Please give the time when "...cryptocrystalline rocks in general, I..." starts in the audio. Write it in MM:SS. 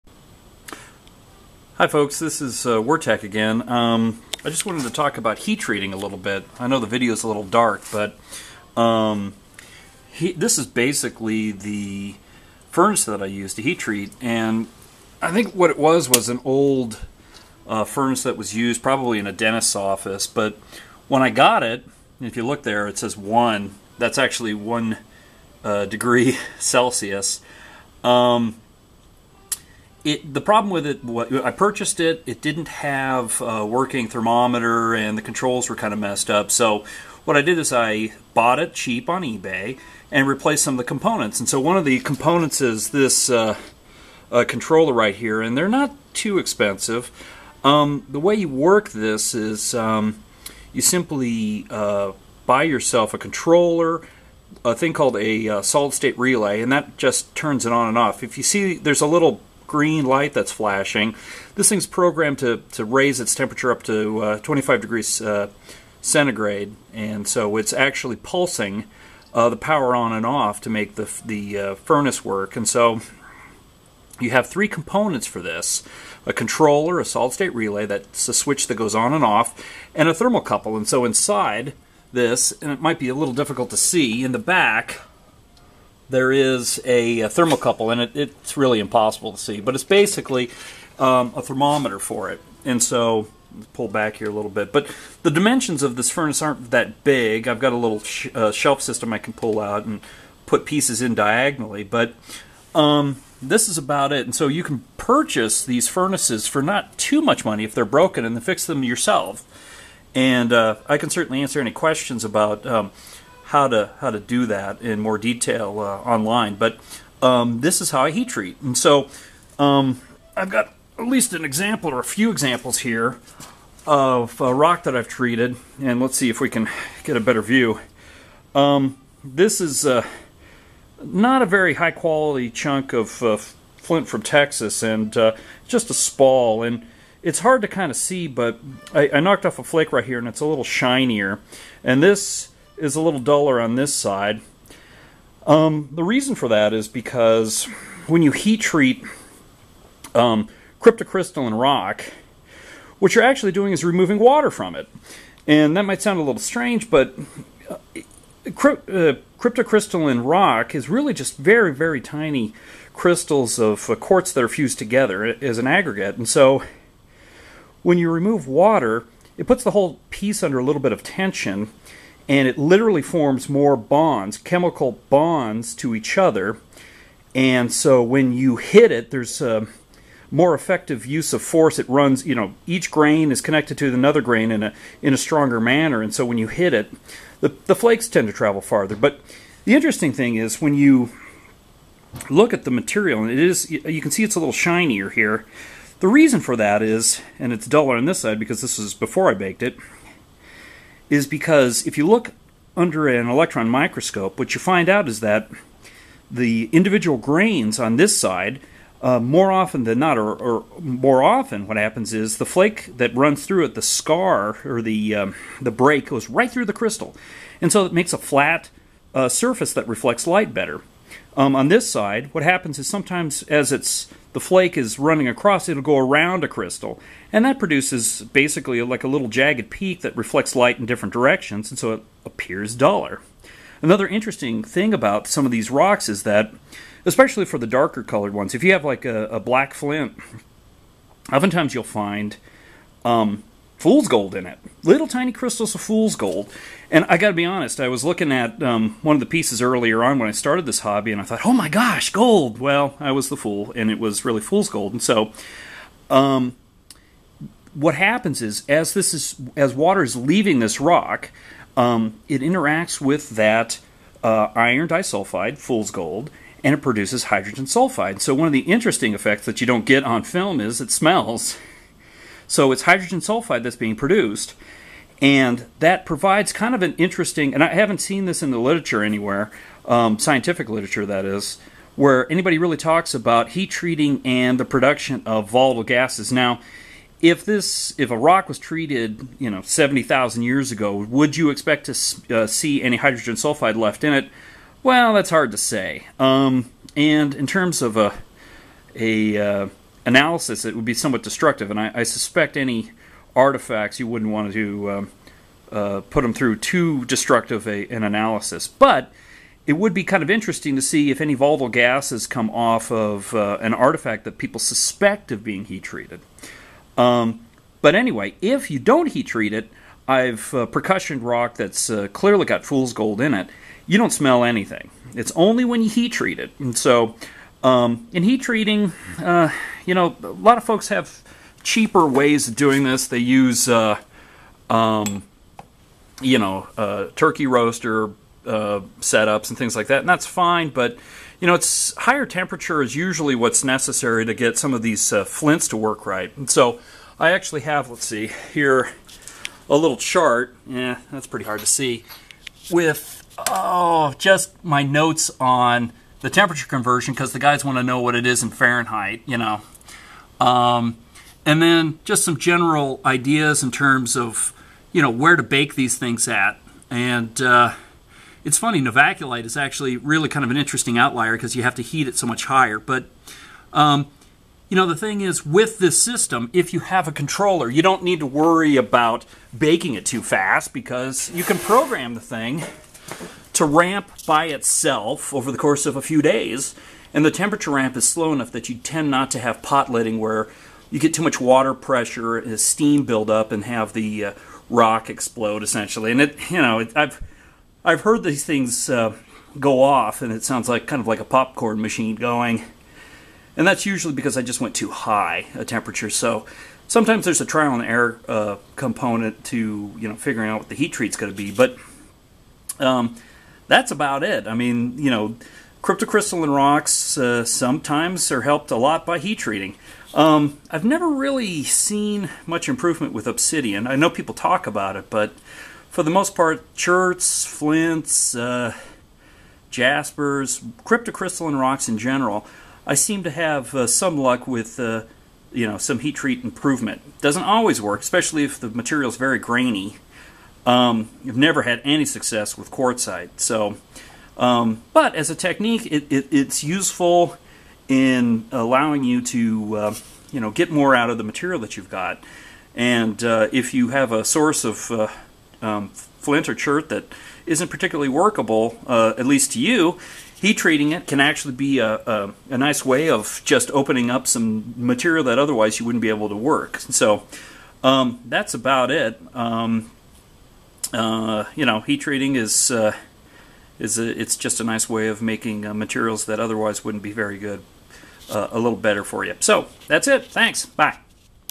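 07:10.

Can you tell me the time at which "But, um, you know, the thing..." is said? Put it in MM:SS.
06:12.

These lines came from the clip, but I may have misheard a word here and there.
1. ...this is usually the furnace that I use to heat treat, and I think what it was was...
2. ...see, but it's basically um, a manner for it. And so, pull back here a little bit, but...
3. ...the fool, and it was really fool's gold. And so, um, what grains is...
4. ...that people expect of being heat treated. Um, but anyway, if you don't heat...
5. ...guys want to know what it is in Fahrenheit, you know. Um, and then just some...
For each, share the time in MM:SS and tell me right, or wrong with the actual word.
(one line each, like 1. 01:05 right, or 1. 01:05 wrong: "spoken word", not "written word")
1. 00:10 wrong: "basically", not "usually"
2. 01:29 wrong: "thermometer", not "manner"
3. 04:13 wrong: "happens", not "grains"
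4. 05:14 wrong: "suspect", not "expect"
5. 05:57 right.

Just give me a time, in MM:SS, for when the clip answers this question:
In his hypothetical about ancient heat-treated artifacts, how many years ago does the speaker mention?
04:49.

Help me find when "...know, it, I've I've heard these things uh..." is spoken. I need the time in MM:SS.
06:36.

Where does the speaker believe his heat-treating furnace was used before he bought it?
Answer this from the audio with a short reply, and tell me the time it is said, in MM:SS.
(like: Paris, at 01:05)
A dentist's office, at 00:19.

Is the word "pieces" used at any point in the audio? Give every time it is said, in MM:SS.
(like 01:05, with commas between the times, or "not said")
01:40, 02:50, 04:09.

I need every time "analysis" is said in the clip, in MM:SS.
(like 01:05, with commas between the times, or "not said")
05:00, 05:08.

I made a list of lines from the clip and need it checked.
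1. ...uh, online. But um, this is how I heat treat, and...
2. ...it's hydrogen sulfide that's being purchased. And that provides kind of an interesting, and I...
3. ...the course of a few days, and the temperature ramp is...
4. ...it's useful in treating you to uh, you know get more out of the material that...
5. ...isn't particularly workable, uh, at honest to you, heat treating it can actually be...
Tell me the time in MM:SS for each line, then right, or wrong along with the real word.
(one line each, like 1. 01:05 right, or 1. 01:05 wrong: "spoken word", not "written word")
1. 01:55 right
2. 04:32 wrong: "produced", not "purchased"
3. 06:25 right
4. 07:26 wrong: "allowing", not "treating"
5. 07:37 wrong: "least", not "honest".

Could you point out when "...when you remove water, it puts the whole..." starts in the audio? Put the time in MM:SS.
02:47.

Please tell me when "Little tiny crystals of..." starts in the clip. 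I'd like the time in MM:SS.
04:04.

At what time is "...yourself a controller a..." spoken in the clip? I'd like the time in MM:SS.
00:52.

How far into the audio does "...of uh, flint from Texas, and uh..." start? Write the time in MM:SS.
02:12.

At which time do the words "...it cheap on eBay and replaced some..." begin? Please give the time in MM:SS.
00:38.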